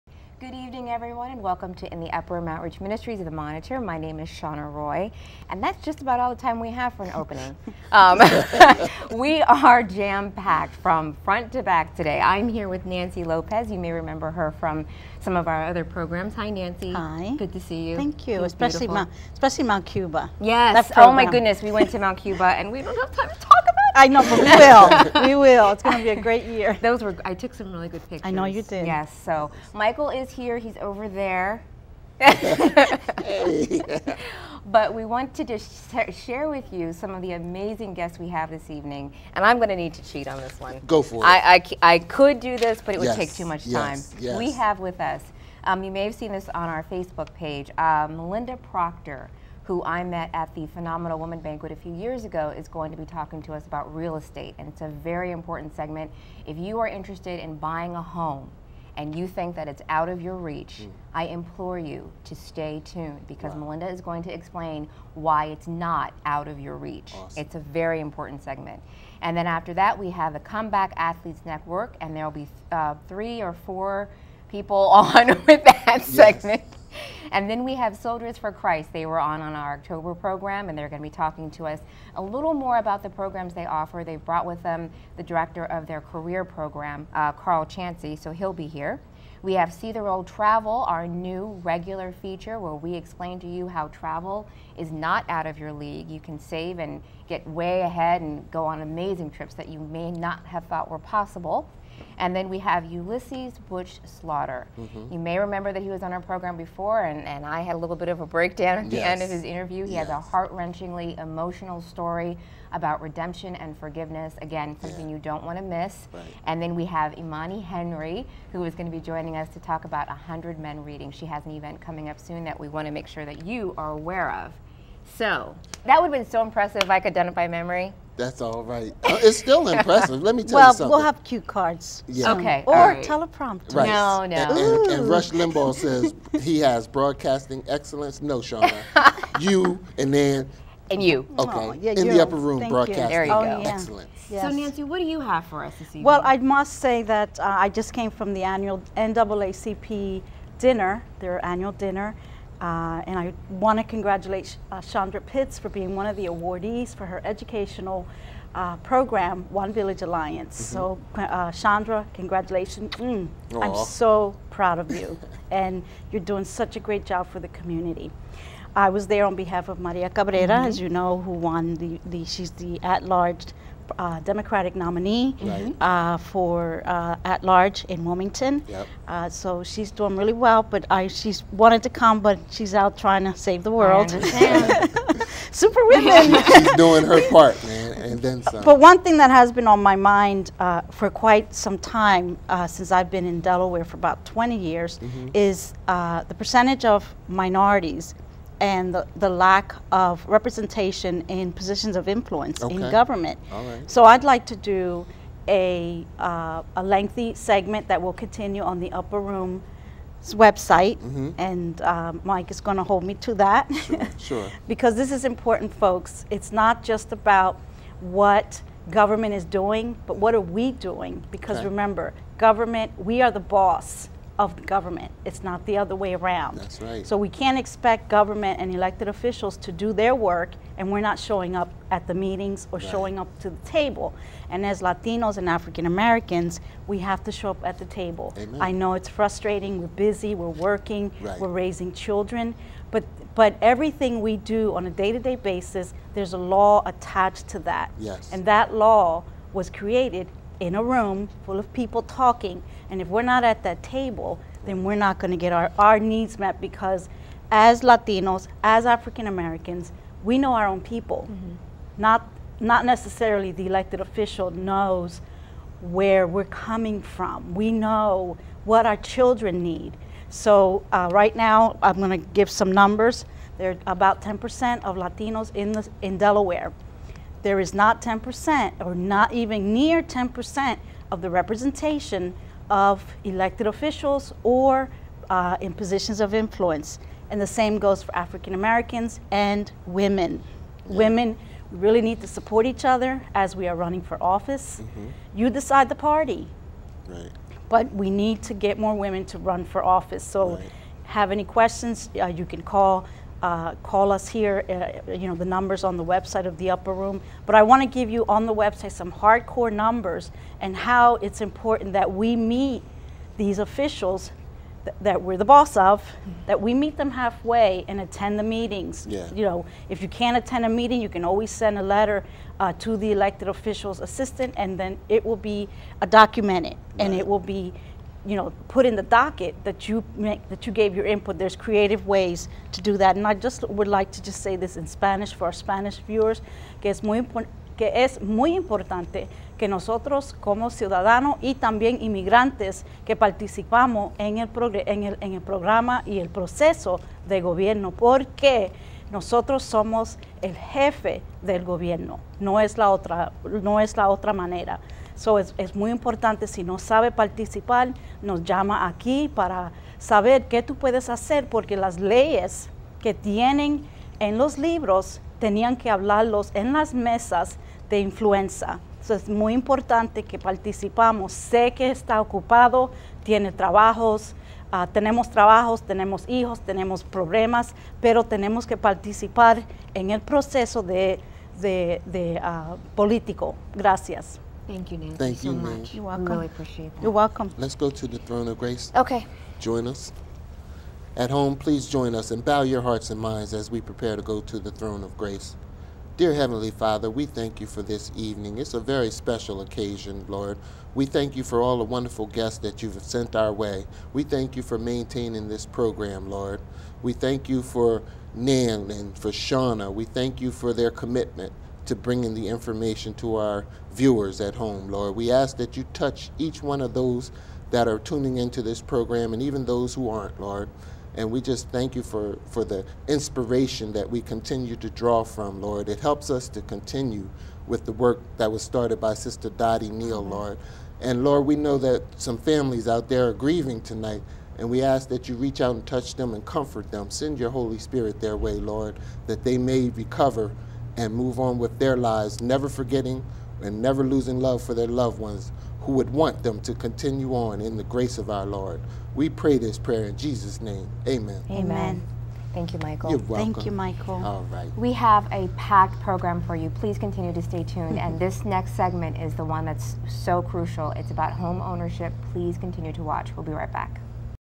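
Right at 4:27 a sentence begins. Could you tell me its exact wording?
We know what our children need.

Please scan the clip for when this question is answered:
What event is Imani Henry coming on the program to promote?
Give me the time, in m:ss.
2:00.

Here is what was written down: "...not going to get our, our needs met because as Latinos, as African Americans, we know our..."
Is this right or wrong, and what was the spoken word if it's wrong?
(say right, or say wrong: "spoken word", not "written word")
right.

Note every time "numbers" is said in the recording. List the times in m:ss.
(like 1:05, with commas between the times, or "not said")
4:32, 5:05, 5:09.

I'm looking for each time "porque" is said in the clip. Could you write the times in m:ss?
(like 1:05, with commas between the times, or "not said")
5:47, 6:01.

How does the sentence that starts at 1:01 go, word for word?
I implore you to stay tuned because wow.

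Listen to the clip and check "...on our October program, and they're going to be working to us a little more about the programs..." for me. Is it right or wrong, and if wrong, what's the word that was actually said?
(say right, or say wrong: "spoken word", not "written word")
wrong: "talking", not "working".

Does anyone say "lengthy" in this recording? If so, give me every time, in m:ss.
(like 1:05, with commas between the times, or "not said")
3:26.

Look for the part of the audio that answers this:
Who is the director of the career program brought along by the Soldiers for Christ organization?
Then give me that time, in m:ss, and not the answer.
1:27.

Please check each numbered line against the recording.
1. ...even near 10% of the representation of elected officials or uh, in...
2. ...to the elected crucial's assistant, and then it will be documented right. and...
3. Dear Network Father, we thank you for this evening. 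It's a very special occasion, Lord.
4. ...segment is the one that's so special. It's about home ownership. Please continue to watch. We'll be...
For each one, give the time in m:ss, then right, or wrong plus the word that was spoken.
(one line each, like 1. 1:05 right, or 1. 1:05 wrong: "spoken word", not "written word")
1. 4:39 right
2. 5:22 wrong: "official", not "crucial"
3. 6:36 wrong: "Heavenly", not "Network"
4. 7:38 wrong: "crucial", not "special".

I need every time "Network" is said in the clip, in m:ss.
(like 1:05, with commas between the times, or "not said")
1:11.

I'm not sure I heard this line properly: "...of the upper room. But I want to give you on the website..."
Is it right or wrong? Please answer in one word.
right.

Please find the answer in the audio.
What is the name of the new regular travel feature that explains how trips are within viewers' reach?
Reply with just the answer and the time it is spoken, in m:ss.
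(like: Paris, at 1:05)
See the Road Travel, at 1:29.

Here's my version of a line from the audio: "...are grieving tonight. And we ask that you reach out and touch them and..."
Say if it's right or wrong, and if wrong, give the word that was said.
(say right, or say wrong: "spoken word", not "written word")
right.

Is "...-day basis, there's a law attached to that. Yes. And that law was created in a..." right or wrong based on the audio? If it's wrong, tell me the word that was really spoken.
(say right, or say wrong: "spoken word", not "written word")
right.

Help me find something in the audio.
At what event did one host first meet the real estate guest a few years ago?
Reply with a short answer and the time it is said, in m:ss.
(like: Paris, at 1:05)
Phenomenal Woman Banquet, at 0:50.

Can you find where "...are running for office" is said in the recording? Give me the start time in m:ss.
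4:53.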